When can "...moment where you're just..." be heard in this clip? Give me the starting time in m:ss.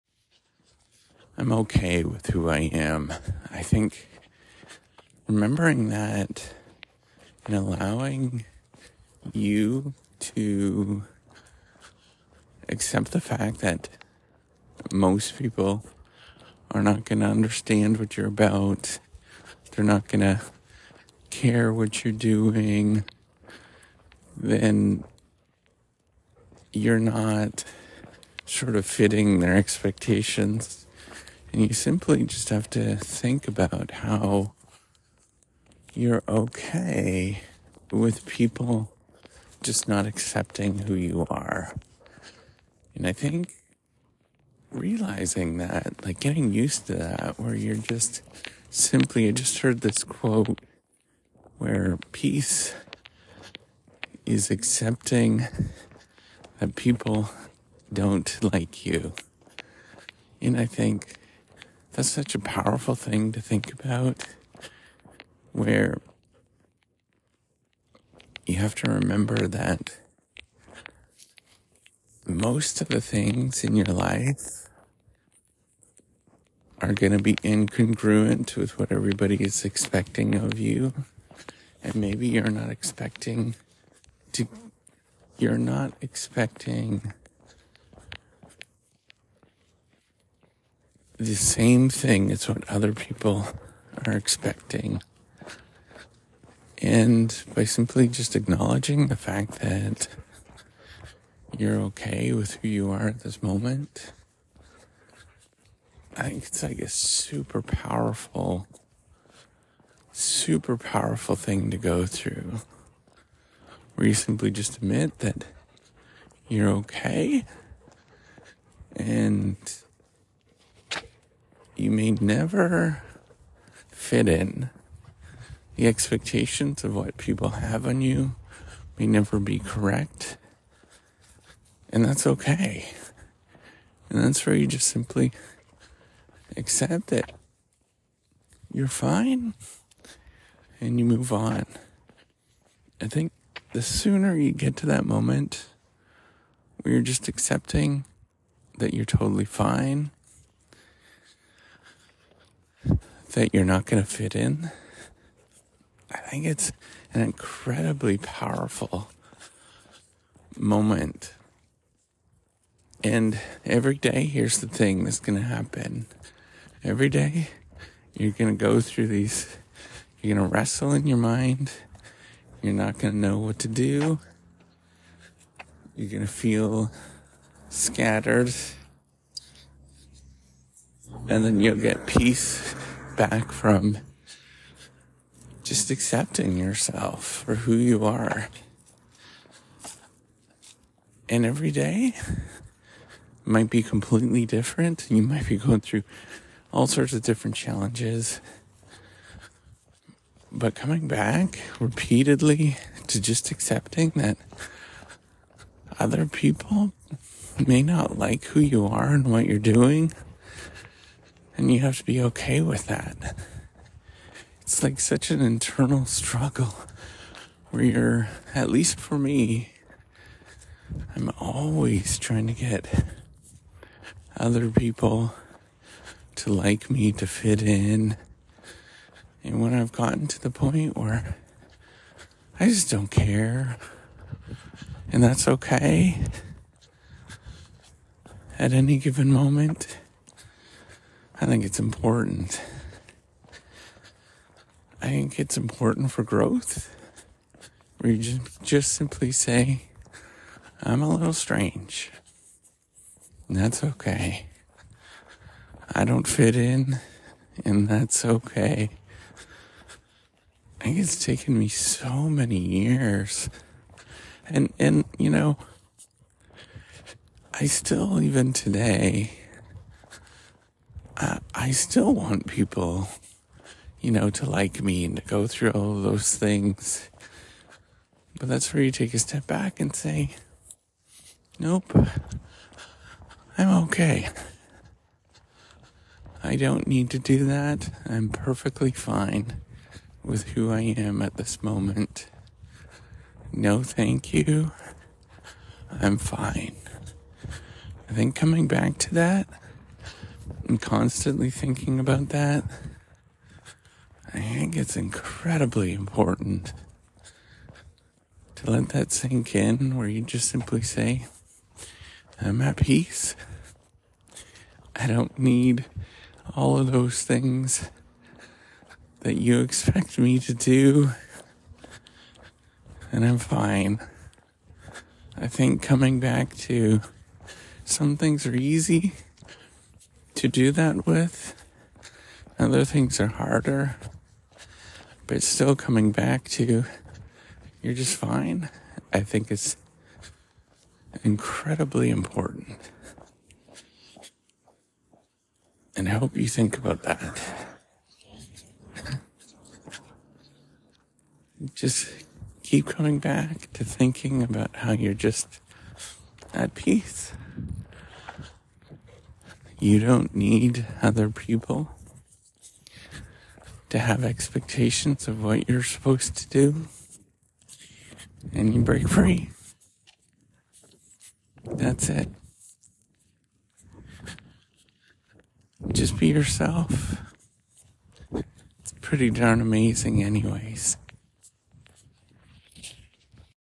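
2:25.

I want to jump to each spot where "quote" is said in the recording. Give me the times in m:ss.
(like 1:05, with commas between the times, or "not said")
0:50.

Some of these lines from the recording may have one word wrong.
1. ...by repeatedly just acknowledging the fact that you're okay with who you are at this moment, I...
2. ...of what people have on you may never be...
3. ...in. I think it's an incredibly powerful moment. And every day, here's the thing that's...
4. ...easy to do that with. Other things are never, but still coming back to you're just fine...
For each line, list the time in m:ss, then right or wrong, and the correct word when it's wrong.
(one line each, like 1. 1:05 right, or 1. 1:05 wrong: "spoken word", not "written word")
1. 1:37 wrong: "simply", not "repeatedly"
2. 2:06 right
3. 2:34 right
4. 5:28 wrong: "harder", not "never".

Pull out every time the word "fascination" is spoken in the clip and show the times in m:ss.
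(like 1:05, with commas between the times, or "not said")
not said.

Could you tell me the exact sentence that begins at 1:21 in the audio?
And maybe you're not expecting to, you're not expecting the same thing as what other people are expecting.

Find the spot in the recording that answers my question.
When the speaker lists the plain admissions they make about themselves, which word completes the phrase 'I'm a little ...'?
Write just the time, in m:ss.
4:11.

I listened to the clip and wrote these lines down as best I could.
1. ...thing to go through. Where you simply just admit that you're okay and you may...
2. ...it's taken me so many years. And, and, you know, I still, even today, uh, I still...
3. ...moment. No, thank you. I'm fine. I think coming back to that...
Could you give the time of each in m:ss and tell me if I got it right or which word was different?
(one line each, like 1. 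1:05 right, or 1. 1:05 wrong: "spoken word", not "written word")
1. 1:51 right
2. 4:20 right
3. 4:51 right.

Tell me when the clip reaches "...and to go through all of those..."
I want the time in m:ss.
4:35.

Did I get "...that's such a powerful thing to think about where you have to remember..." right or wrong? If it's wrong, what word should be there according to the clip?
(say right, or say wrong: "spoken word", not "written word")
right.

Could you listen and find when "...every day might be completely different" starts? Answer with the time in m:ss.
3:11.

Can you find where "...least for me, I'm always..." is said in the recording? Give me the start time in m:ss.
3:38.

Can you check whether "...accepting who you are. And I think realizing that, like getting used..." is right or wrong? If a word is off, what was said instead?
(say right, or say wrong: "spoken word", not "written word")
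right.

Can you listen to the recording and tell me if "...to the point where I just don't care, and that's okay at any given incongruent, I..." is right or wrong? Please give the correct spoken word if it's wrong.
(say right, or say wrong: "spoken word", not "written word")
wrong: "moment", not "incongruent".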